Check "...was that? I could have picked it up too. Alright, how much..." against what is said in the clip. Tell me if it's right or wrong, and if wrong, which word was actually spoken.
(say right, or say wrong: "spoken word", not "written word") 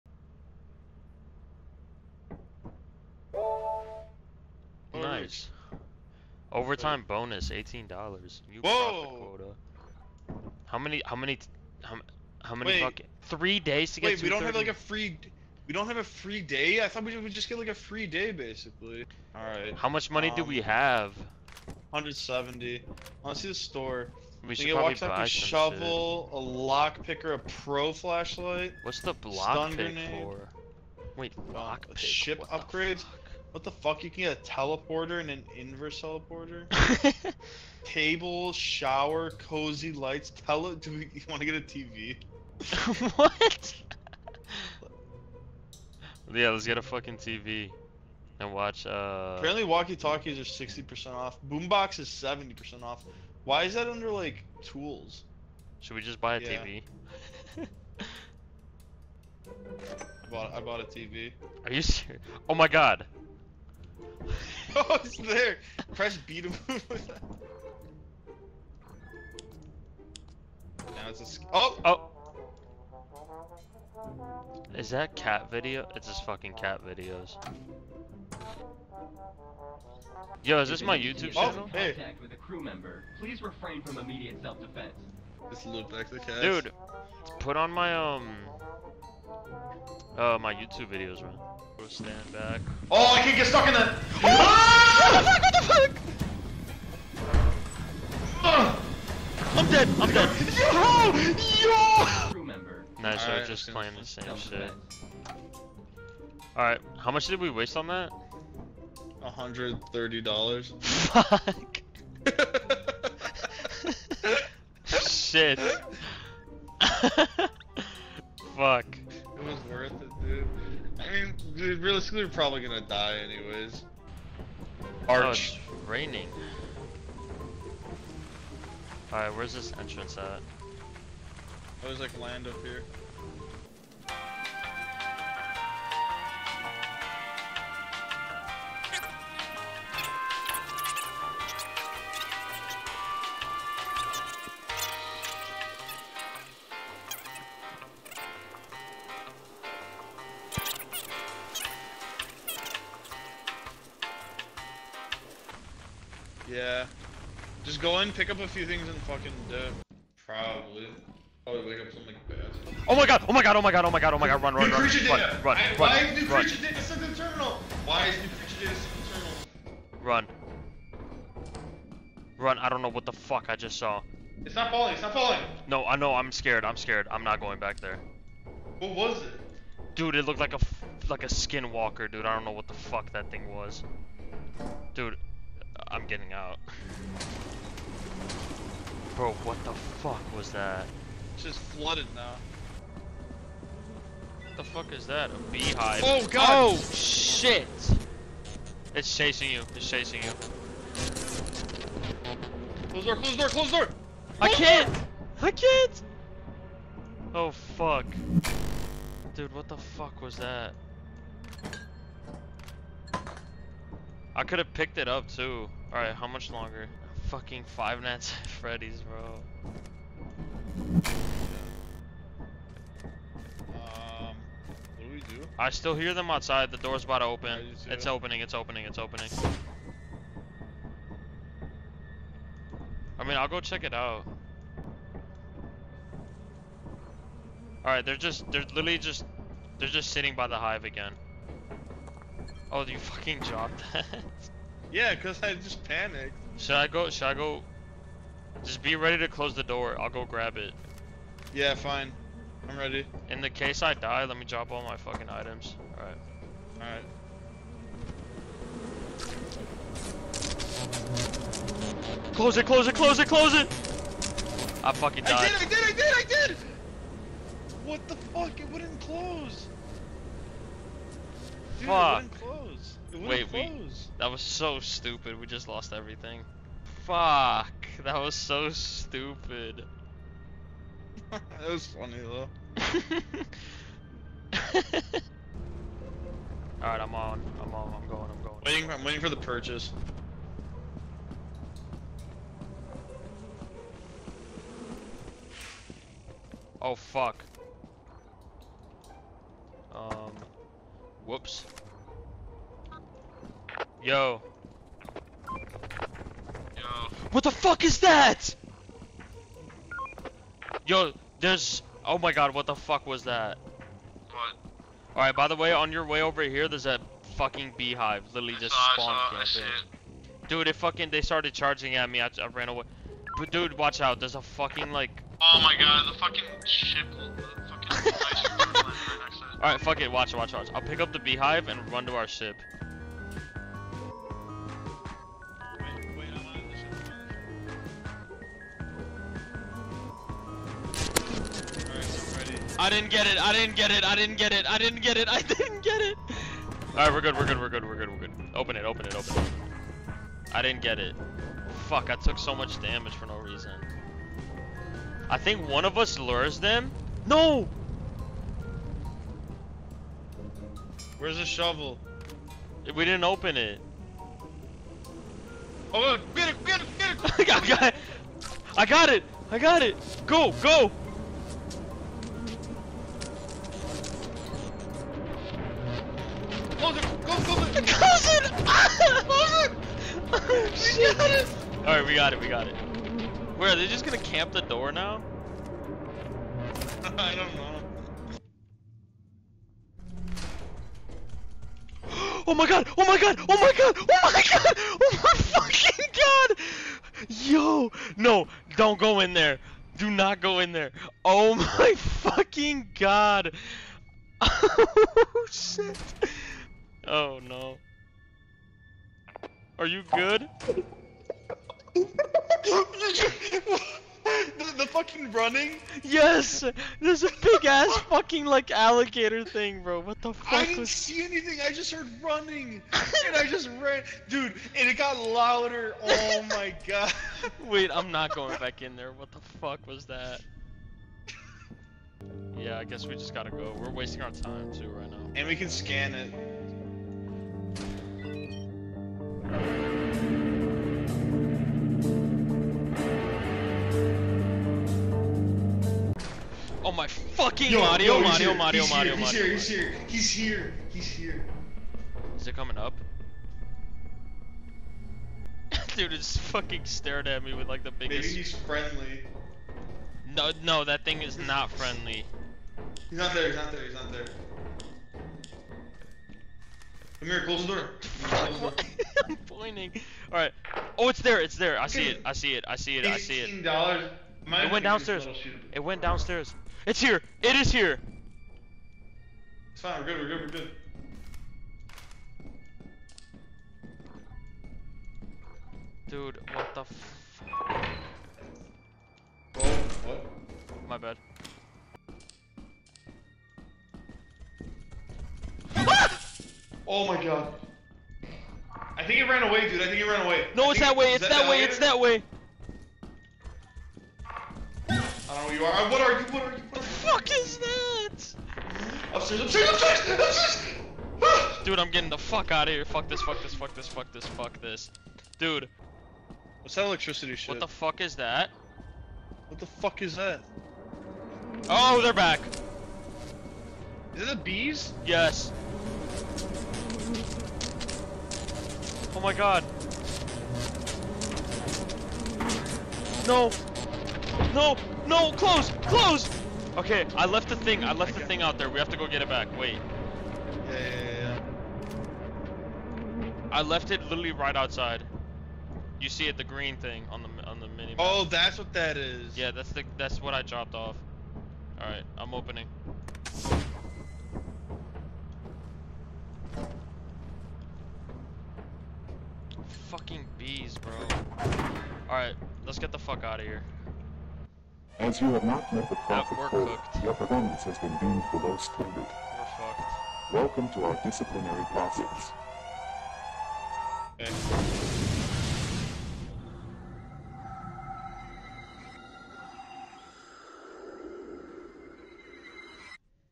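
right.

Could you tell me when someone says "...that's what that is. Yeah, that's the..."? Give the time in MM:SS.
09:08.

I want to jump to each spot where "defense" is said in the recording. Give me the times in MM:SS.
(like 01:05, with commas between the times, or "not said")
01:24.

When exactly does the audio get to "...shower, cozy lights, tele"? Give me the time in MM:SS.
00:38.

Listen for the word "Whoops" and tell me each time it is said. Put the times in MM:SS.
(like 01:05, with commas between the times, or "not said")
05:01.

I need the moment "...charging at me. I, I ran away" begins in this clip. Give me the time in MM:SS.
05:21.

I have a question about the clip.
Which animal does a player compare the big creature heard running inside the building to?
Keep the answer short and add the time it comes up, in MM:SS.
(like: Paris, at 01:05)
Alligator, at 06:58.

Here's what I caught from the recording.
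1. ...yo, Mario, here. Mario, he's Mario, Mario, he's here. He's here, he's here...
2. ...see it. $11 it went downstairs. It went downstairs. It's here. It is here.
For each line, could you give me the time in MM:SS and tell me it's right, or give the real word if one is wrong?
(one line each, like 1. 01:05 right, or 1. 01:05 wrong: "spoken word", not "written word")
1. 07:28 right
2. 07:53 wrong: "18", not "11".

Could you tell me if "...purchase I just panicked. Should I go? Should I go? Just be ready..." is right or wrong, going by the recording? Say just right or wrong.
wrong.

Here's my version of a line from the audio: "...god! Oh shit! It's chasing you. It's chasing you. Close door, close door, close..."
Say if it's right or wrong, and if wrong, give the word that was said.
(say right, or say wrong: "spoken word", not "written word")
right.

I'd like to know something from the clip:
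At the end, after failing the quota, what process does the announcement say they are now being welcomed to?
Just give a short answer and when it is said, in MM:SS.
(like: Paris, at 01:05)
Disciplinary process, at 09:31.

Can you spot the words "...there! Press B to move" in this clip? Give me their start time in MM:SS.
01:05.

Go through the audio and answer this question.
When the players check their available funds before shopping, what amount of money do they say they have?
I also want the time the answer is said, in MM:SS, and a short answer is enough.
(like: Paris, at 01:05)
170, at 00:21.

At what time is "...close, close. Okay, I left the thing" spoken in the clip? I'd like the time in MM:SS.
08:55.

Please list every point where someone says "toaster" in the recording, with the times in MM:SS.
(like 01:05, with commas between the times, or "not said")
not said.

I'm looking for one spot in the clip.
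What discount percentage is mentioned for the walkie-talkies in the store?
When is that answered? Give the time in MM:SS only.
00:50.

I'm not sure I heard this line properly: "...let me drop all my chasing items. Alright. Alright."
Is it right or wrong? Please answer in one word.
wrong.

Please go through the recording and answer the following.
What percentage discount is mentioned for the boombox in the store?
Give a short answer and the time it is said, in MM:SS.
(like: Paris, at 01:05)
70%, at 00:52.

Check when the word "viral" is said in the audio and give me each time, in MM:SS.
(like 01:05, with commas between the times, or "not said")
not said.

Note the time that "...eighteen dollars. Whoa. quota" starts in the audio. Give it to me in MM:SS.
00:07.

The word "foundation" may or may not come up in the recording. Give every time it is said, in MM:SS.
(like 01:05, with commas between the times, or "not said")
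not said.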